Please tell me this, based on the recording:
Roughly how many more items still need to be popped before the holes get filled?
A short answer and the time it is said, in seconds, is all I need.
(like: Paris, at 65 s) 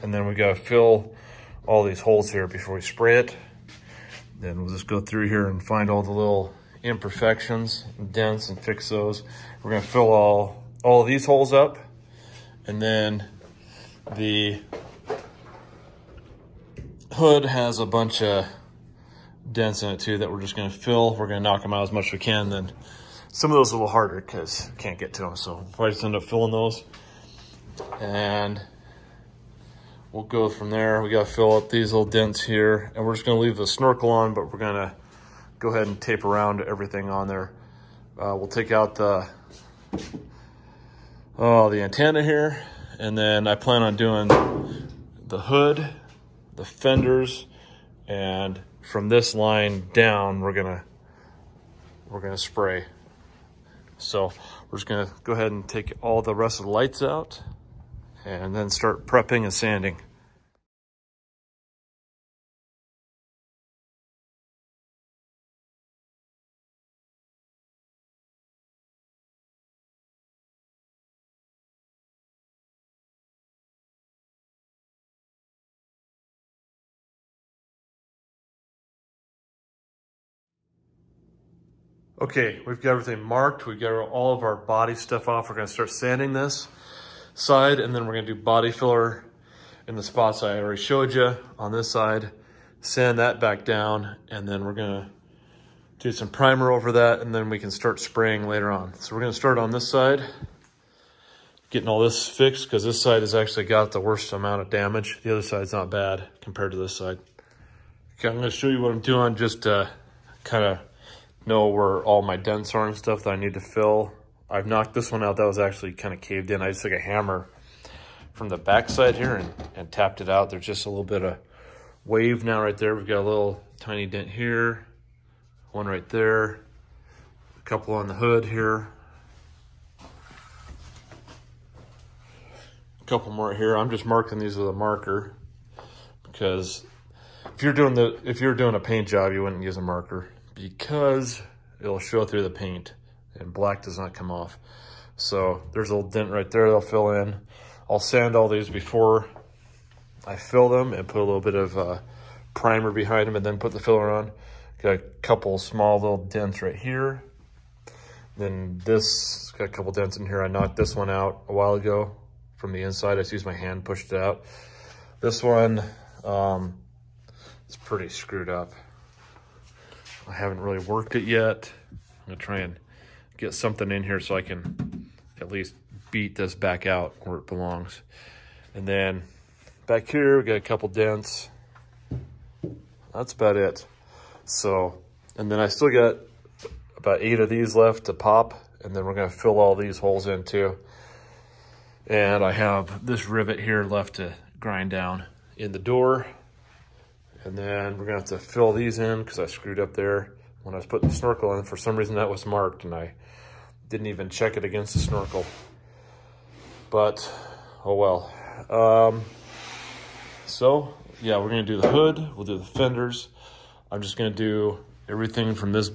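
8, at 187 s.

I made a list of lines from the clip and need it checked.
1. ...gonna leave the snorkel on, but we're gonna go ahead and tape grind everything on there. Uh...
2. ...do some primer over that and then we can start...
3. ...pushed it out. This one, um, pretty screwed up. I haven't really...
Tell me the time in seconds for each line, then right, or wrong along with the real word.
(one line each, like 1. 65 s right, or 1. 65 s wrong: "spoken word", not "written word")
1. 33 s wrong: "around", not "grind"
2. 95 s right
3. 163 s right.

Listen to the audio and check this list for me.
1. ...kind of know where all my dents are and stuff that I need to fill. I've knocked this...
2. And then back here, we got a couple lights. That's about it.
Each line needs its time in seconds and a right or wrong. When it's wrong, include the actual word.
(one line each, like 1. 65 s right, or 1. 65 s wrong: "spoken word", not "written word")
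1. 109 s right
2. 178 s wrong: "dents", not "lights".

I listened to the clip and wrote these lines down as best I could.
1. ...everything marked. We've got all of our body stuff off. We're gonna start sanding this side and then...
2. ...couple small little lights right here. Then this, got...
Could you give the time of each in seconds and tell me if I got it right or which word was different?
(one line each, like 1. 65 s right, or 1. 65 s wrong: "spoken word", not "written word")
1. 82 s right
2. 154 s wrong: "dents", not "lights".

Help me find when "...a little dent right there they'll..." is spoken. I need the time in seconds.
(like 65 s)
145 s.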